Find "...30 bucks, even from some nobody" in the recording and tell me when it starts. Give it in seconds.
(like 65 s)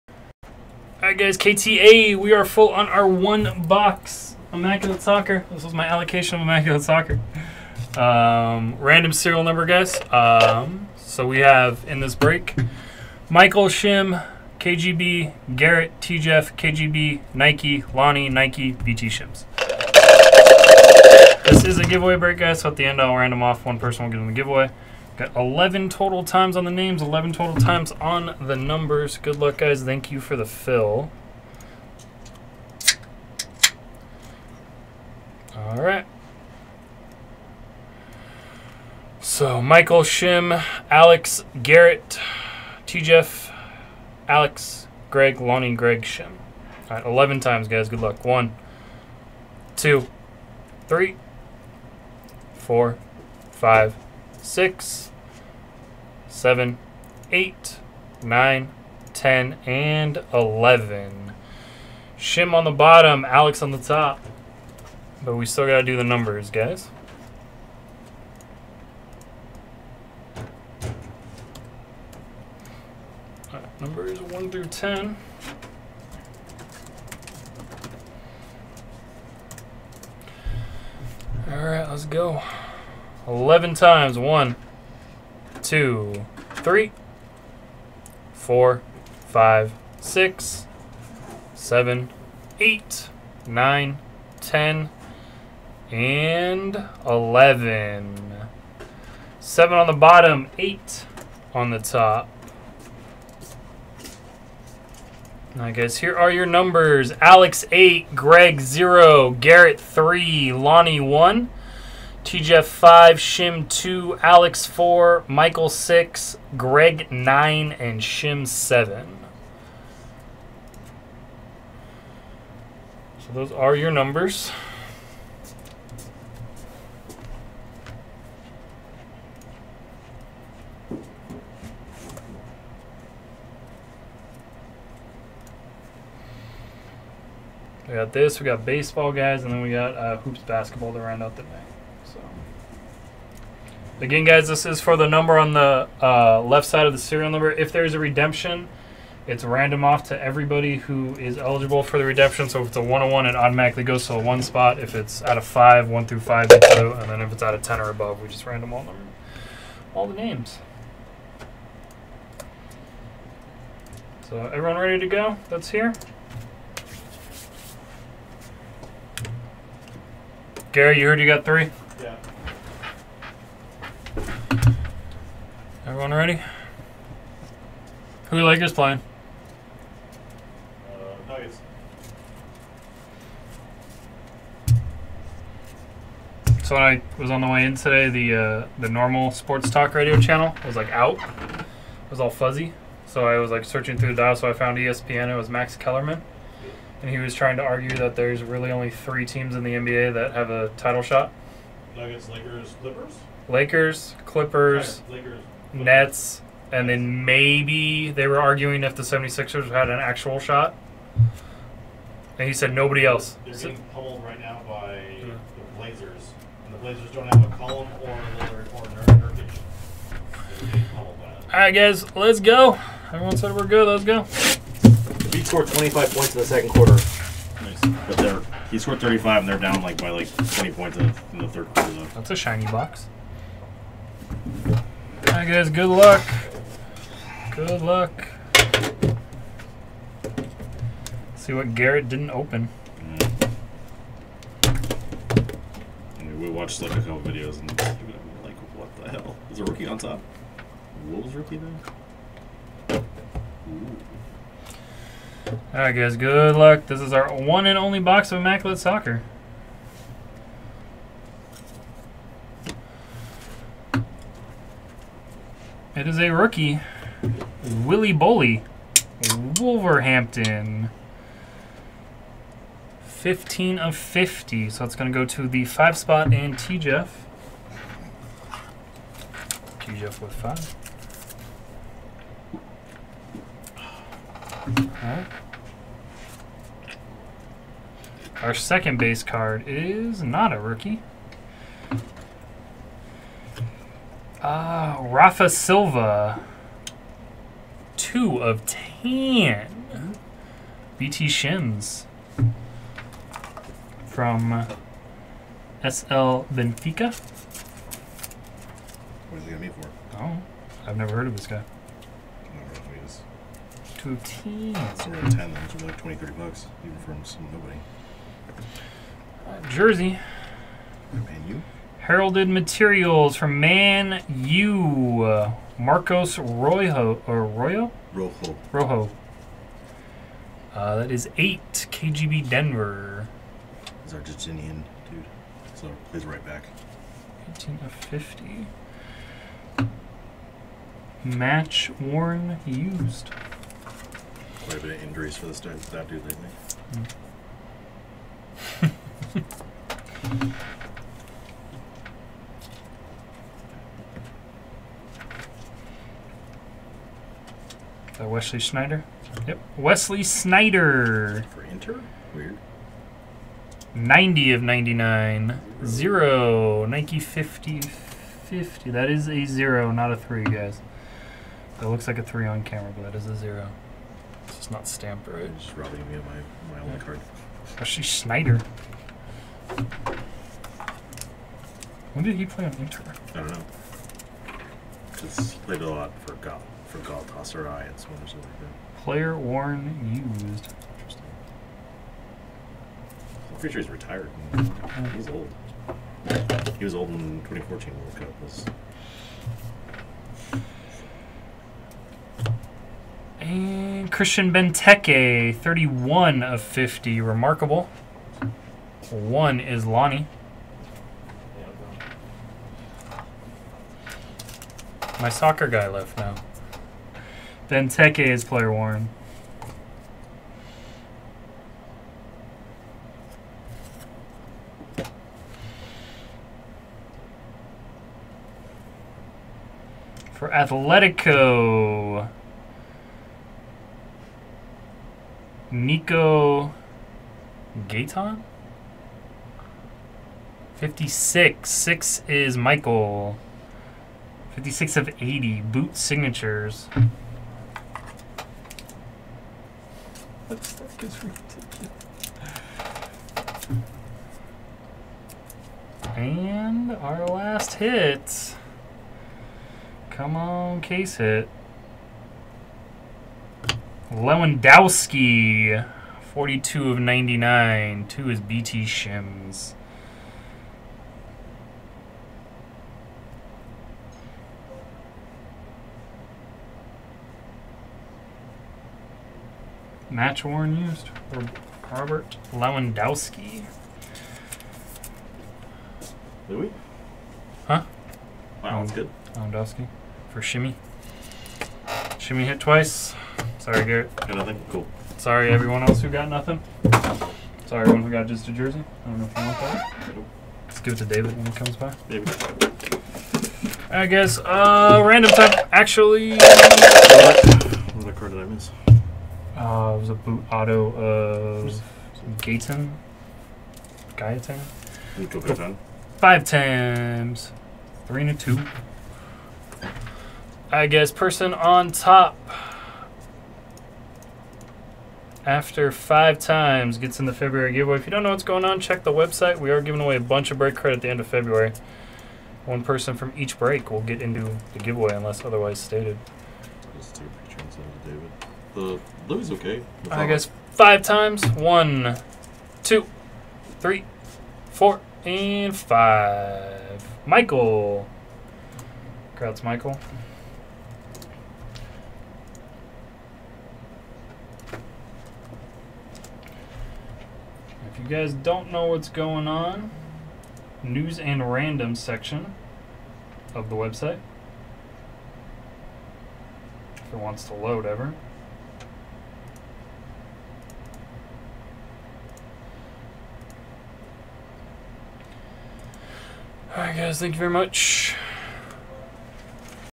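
316 s.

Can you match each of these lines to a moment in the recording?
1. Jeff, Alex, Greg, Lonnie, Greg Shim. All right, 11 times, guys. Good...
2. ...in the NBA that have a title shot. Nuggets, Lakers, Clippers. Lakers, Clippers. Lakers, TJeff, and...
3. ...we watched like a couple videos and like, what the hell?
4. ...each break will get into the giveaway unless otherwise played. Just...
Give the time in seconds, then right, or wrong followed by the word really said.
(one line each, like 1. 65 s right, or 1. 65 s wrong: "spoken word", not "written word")
1. 43 s right
2. 199 s wrong: "Nets", not "TJeff"
3. 246 s right
4. 533 s wrong: "stated", not "played".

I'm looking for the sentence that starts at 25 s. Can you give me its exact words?
Got 11 total times on the names, 11 total times on the numbers.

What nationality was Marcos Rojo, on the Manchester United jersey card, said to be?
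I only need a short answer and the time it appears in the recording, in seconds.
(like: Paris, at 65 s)
Argentinian, at 334 s.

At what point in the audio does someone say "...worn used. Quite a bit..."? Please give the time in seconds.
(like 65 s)
342 s.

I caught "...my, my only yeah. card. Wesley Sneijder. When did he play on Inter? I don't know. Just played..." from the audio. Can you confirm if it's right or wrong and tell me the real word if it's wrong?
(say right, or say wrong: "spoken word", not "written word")
right.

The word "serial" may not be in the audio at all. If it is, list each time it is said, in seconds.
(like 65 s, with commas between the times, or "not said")
9 s, 146 s.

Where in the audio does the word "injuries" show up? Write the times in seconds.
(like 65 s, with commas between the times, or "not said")
345 s.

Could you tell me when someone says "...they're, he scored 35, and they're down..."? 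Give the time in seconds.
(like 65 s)
228 s.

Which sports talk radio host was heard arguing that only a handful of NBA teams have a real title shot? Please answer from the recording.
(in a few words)
Max Kellerman.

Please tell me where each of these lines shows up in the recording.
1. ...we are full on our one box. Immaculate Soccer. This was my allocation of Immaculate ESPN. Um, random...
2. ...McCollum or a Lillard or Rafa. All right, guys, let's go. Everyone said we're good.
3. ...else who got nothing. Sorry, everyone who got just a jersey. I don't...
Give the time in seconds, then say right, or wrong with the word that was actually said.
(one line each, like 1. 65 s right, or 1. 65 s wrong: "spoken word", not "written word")
1. 2 s wrong: "Soccer", not "ESPN"
2. 217 s wrong: "Nurkic", not "Rafa"
3. 495 s right.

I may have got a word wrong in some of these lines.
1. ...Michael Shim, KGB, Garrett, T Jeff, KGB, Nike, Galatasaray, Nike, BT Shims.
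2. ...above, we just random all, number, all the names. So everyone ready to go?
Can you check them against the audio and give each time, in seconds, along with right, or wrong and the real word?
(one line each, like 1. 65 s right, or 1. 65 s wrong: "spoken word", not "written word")
1. 13 s wrong: "Lonnie", not "Galatasaray"
2. 157 s right.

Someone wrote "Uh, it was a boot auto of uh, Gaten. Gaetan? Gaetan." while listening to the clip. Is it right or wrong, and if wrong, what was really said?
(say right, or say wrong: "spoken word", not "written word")
right.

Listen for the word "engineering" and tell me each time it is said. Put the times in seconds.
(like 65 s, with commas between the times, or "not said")
not said.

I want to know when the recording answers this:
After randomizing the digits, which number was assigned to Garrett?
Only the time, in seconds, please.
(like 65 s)
109 s.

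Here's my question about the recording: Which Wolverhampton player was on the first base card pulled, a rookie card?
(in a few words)
Willy Boly.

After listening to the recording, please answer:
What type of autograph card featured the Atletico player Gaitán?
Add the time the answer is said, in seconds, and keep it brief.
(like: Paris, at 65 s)
Boot signatures, at 445 s.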